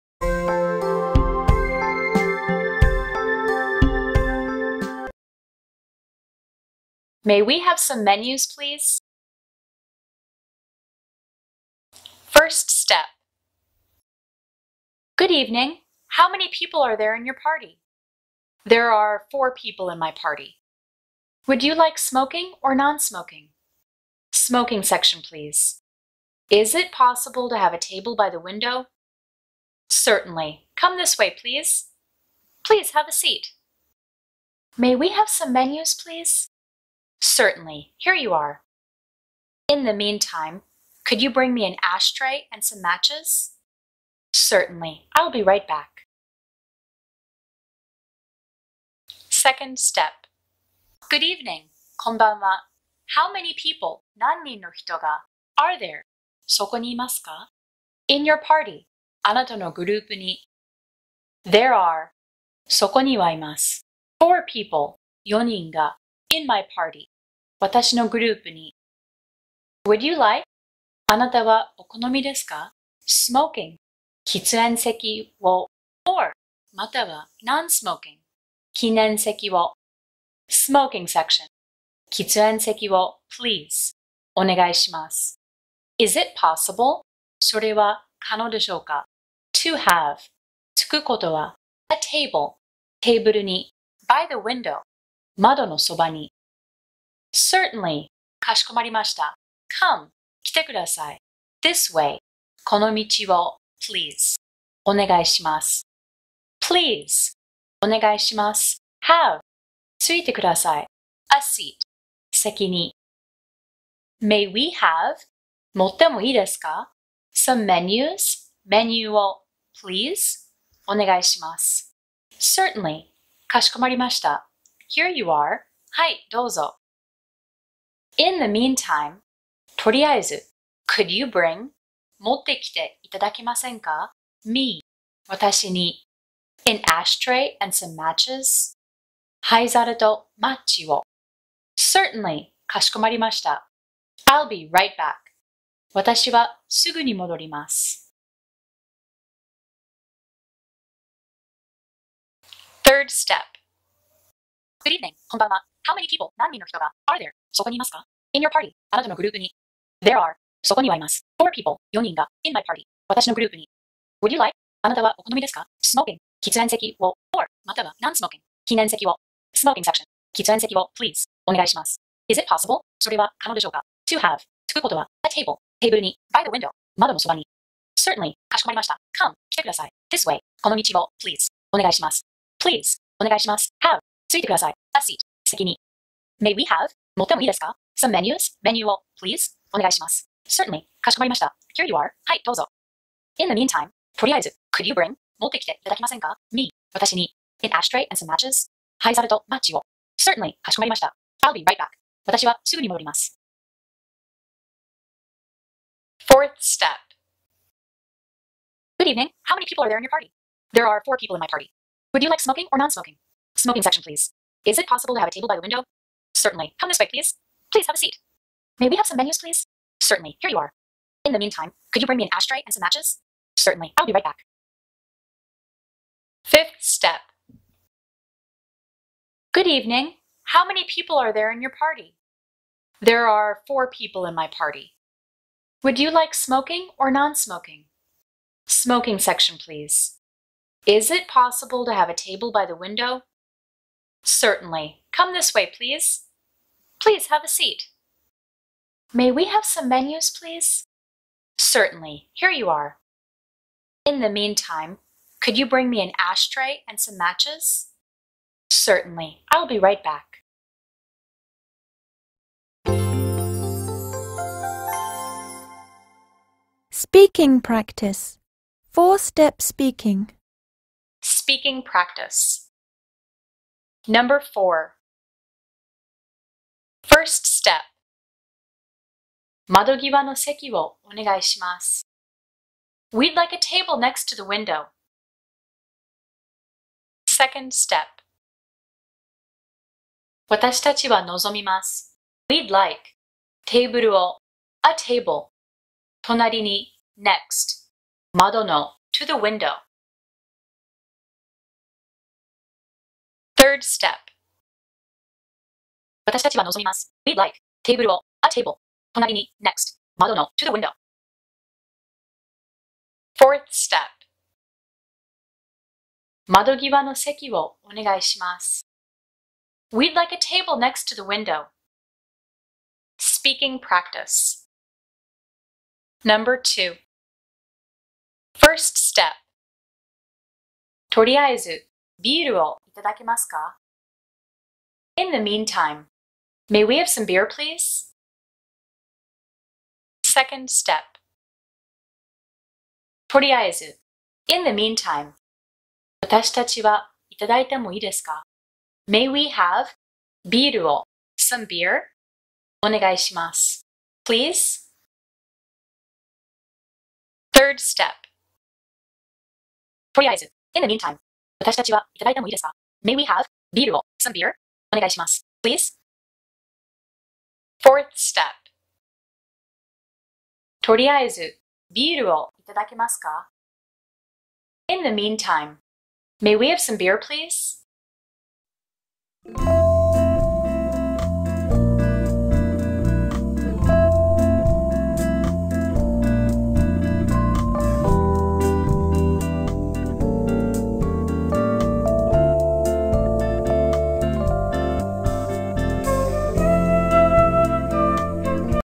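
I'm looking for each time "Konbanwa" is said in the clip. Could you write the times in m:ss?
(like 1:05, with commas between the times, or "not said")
0:51.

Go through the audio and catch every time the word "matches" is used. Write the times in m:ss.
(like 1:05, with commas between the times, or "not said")
0:42, 2:17, 3:18, 3:42, 4:17.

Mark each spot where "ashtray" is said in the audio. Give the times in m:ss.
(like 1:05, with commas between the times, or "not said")
0:41, 2:16, 3:17, 3:42, 4:16.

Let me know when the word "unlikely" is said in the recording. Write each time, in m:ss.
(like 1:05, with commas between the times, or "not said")
not said.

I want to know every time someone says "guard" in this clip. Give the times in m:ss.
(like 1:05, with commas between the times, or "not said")
not said.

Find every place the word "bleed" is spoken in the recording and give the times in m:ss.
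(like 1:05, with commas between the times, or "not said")
not said.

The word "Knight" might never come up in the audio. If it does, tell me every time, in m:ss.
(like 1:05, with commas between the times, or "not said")
not said.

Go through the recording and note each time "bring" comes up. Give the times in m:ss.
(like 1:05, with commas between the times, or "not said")
0:41, 2:11, 3:14, 3:42, 4:15.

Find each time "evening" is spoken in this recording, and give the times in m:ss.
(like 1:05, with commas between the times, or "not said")
0:15, 0:51, 2:34, 3:29, 3:49.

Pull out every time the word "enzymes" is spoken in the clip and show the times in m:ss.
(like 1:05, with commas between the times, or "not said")
not said.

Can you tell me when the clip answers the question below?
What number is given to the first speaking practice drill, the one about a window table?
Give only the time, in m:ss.
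4:34.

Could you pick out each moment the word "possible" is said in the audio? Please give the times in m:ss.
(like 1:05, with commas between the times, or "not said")
0:26, 1:26, 2:52, 3:34, 4:01.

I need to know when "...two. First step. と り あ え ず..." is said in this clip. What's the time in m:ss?
5:26.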